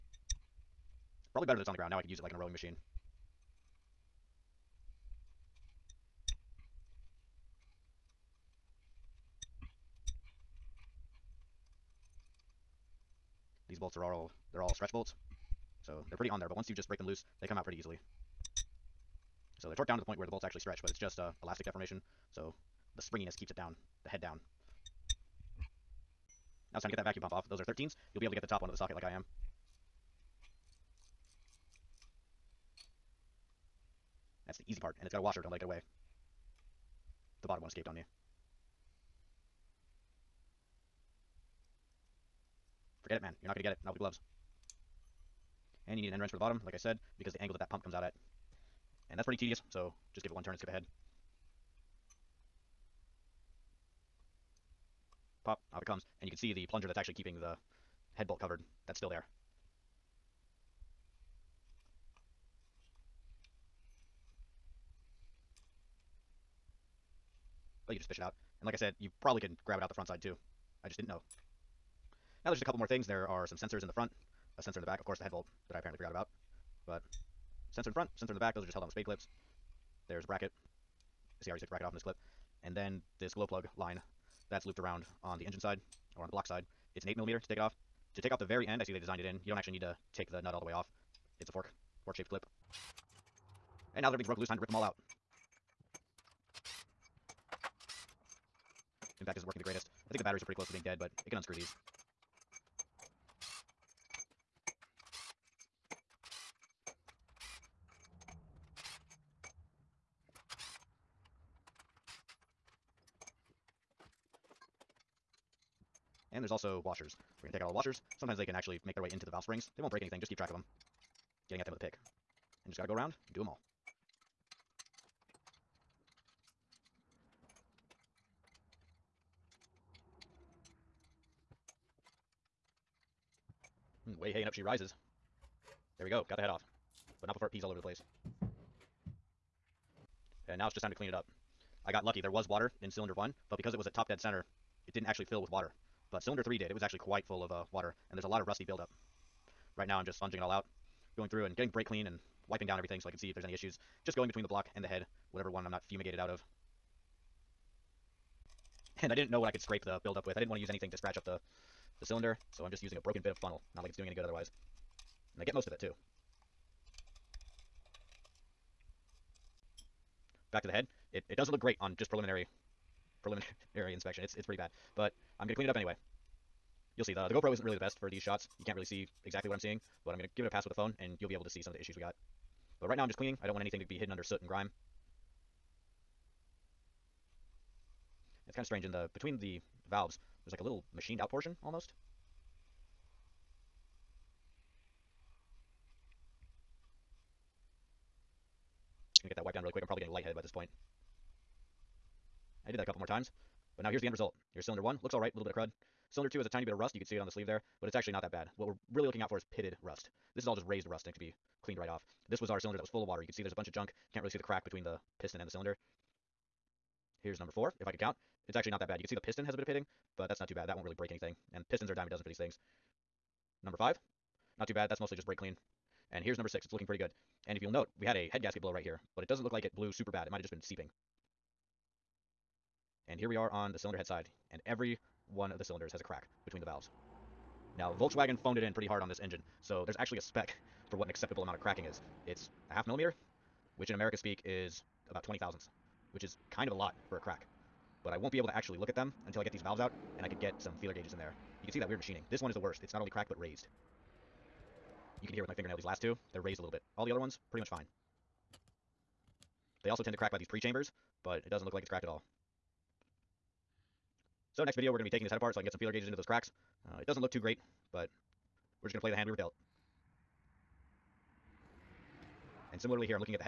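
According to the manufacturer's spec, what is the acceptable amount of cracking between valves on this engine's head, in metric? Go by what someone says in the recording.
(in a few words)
0.5 millimeter.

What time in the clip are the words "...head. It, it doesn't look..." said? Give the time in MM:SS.
02:50.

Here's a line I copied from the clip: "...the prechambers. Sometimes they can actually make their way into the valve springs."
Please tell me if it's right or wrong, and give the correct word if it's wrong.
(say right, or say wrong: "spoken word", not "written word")
wrong: "washers", not "prechambers".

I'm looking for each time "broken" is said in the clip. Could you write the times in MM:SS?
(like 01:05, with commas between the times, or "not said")
01:34, 02:42.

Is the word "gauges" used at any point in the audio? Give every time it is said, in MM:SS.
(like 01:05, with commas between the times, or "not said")
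04:10, 04:25.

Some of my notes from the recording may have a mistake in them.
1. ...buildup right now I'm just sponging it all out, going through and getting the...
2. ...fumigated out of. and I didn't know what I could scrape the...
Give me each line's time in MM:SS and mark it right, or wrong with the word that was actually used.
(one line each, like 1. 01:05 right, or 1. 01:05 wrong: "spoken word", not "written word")
1. 02:28 right
2. 02:35 right.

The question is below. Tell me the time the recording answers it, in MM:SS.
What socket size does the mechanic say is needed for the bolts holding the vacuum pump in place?
00:27.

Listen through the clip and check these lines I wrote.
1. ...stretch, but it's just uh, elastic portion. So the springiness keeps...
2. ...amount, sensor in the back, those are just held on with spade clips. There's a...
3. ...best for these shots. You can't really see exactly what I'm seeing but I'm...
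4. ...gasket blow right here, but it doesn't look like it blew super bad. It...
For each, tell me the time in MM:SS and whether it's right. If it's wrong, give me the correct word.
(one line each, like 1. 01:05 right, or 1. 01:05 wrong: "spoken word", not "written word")
1. 00:20 wrong: "deformation", not "portion"
2. 01:17 wrong: "front", not "amount"
3. 02:57 right
4. 03:48 right.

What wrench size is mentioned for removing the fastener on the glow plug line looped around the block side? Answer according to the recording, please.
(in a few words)
8 millimeter.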